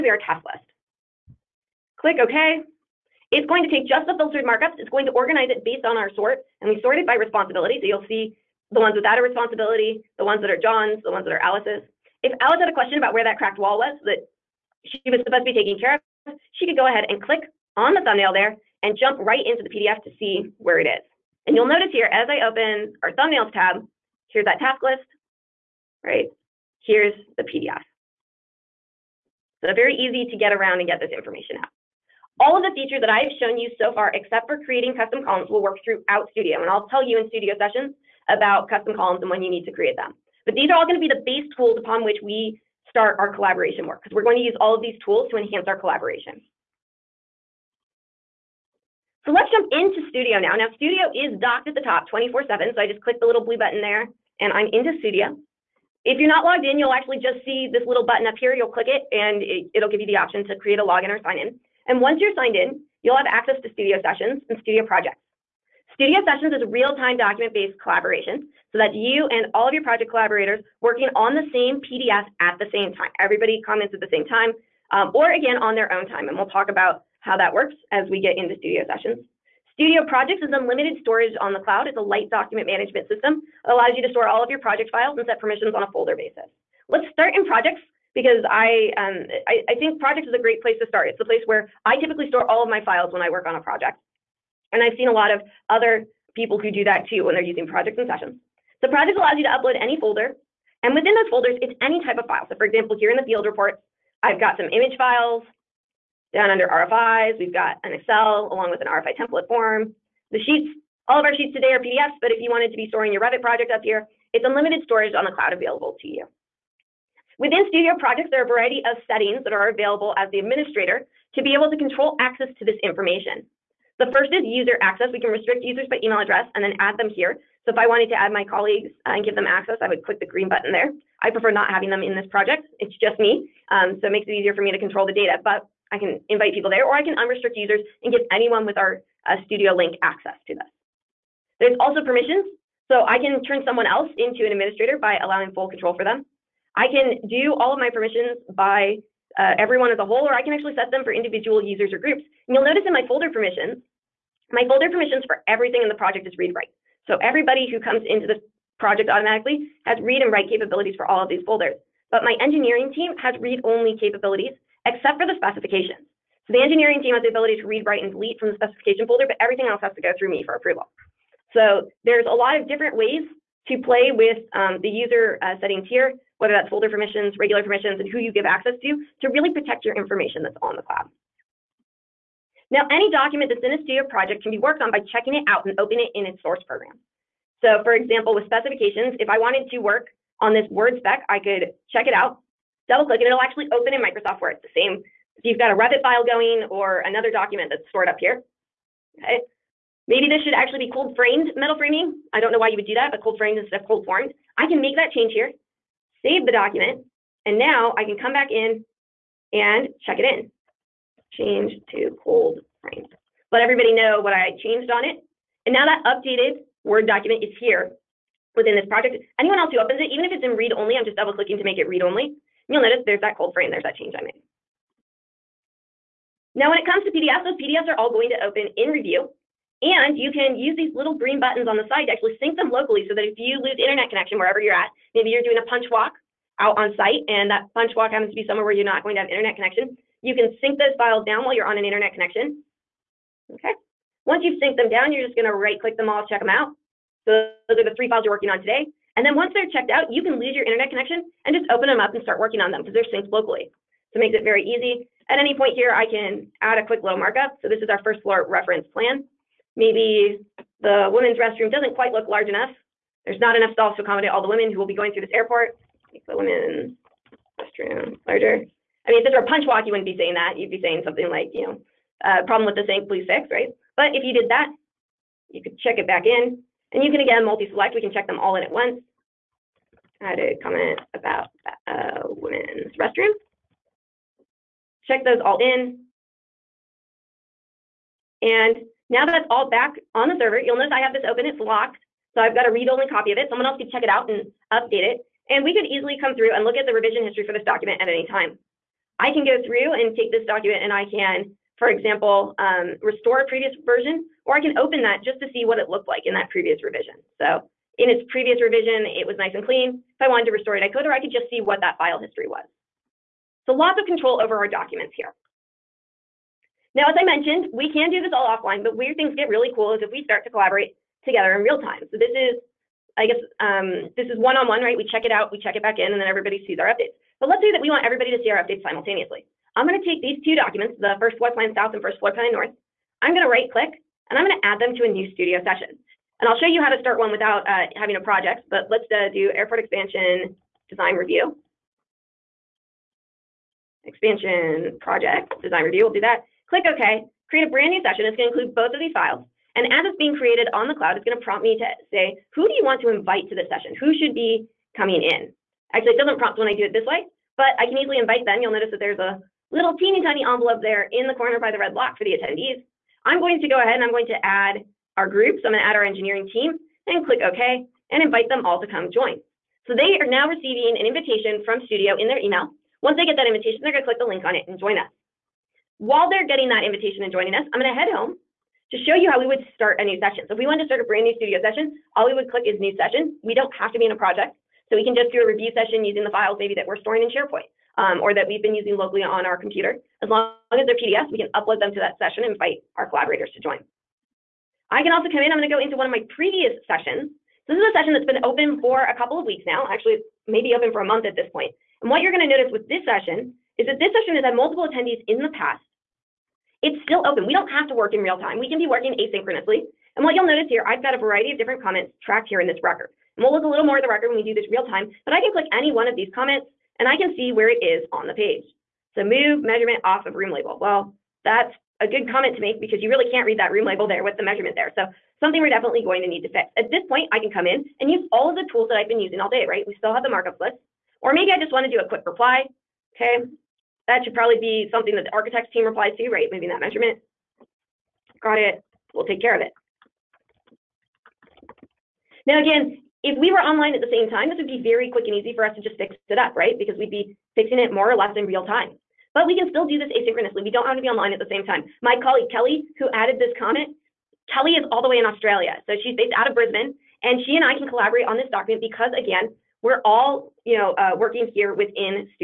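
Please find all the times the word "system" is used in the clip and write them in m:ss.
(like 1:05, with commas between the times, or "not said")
1:23.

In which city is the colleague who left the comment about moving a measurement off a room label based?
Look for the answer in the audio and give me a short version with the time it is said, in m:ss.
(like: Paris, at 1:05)
Brisbane, at 7:36.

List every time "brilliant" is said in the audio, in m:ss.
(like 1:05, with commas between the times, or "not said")
not said.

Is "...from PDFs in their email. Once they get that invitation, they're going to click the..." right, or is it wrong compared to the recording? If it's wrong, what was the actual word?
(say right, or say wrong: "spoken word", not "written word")
wrong: "Studio", not "PDFs".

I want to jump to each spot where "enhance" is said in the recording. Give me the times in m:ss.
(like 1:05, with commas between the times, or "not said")
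0:45.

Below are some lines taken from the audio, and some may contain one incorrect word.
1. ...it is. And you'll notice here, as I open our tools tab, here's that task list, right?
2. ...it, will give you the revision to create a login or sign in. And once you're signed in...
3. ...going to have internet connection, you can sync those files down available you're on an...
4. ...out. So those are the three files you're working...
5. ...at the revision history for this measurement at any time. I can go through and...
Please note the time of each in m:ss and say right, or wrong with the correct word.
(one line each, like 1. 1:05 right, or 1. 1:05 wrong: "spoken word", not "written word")
1. 0:20 wrong: "thumbnails", not "tools"
2. 0:59 wrong: "option", not "revision"
3. 3:59 wrong: "while", not "available"
4. 4:06 right
5. 4:56 wrong: "document", not "measurement".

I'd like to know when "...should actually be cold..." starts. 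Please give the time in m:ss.
3:20.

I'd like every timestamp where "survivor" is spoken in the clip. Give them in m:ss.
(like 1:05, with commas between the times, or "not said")
not said.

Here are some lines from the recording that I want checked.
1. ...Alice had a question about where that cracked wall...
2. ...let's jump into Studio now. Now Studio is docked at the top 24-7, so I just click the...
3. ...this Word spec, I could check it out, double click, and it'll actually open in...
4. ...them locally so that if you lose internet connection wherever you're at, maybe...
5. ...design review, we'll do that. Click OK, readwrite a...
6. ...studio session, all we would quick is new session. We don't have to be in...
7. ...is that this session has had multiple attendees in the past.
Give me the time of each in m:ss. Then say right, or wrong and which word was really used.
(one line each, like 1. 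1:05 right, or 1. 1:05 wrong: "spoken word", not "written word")
1. 0:12 right
2. 0:49 right
3. 3:10 right
4. 3:52 right
5. 5:45 wrong: "create", not "readwrite"
6. 6:21 wrong: "click", not "quick"
7. 6:43 right.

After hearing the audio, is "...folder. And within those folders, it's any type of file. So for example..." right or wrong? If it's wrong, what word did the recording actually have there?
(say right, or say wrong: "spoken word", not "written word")
right.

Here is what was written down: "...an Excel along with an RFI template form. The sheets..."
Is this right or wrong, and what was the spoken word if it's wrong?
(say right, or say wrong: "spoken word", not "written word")
right.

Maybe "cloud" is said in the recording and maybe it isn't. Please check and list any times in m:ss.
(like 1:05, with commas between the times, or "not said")
1:21, 1:55, 3:00, 5:50.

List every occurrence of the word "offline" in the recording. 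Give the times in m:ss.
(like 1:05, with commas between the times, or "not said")
5:18.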